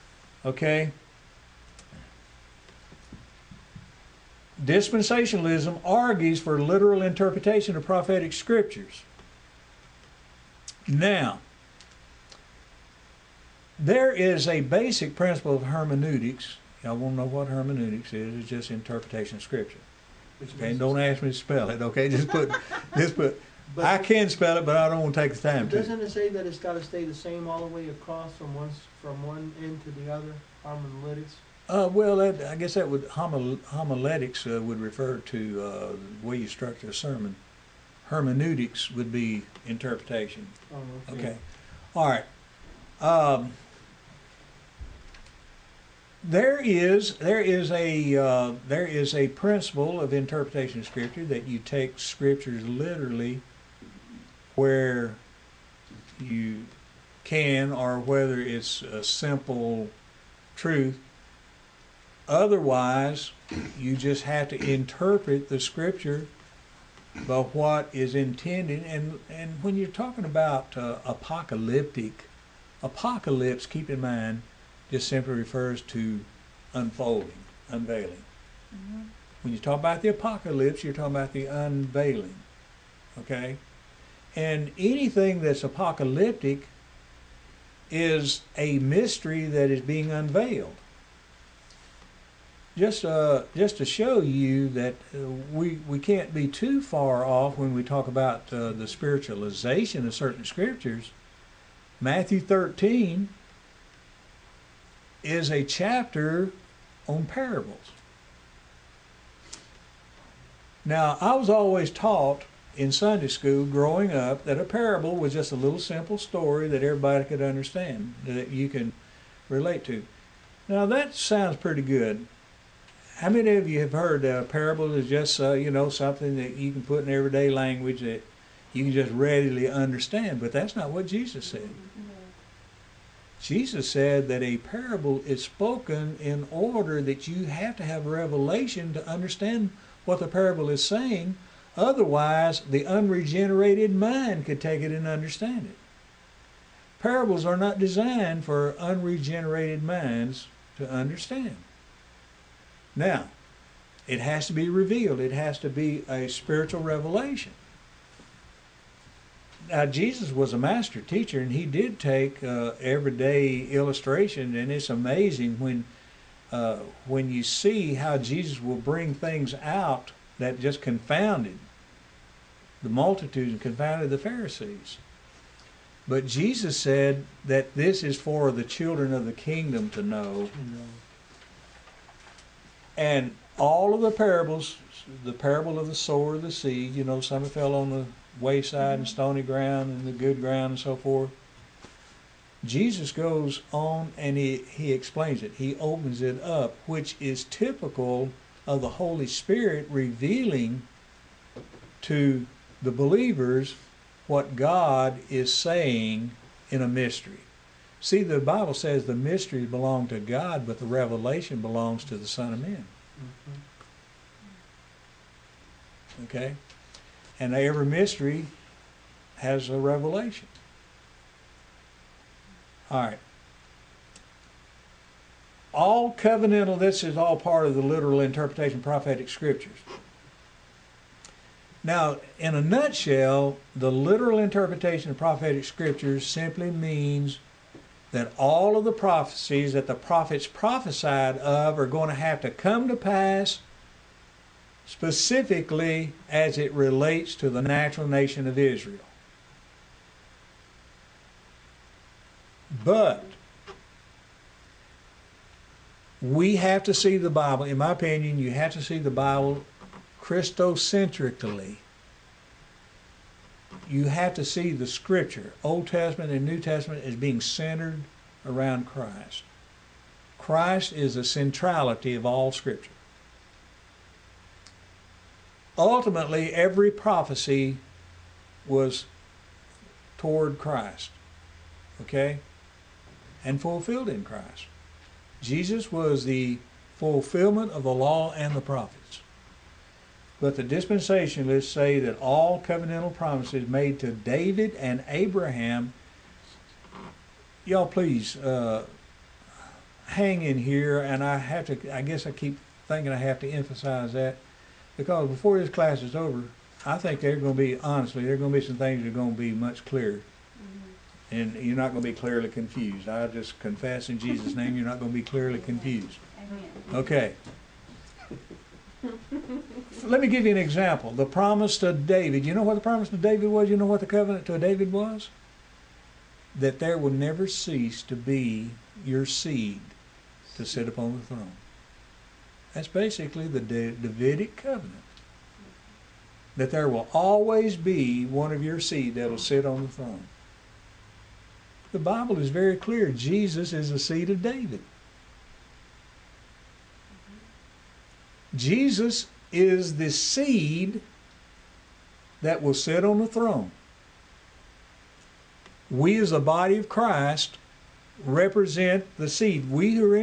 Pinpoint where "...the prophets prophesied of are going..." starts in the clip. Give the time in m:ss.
3:59.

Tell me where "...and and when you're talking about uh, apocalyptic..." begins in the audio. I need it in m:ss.
1:08.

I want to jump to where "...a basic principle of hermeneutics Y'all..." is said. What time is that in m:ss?
0:14.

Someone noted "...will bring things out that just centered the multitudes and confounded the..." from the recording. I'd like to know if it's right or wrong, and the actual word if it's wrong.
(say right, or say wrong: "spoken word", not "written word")
wrong: "confounded", not "centered".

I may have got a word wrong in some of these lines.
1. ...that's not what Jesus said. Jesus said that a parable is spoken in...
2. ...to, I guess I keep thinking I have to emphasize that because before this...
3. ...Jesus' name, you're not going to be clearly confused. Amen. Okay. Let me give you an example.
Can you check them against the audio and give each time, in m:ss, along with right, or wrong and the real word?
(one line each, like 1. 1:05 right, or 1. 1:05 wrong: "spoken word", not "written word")
1. 2:10 right
2. 5:01 right
3. 5:14 right.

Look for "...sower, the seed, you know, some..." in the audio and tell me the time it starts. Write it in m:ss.
3:05.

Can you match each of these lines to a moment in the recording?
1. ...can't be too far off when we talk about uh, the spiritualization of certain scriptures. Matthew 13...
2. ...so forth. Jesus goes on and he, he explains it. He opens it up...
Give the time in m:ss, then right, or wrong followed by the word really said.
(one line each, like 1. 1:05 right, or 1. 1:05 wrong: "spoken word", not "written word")
1. 1:35 right
2. 3:10 right.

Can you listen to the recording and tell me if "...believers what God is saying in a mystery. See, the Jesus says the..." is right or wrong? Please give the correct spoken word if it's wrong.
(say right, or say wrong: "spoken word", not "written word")
wrong: "Bible", not "Jesus".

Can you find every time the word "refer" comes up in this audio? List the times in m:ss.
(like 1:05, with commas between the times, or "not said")
0:34, 1:15.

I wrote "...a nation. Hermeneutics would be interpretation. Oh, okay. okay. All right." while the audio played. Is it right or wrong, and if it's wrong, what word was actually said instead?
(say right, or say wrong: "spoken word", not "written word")
wrong: "sermon", not "nation".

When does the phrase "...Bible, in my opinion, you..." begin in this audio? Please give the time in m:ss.
4:17.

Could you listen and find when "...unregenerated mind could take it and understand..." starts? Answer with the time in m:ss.
2:22.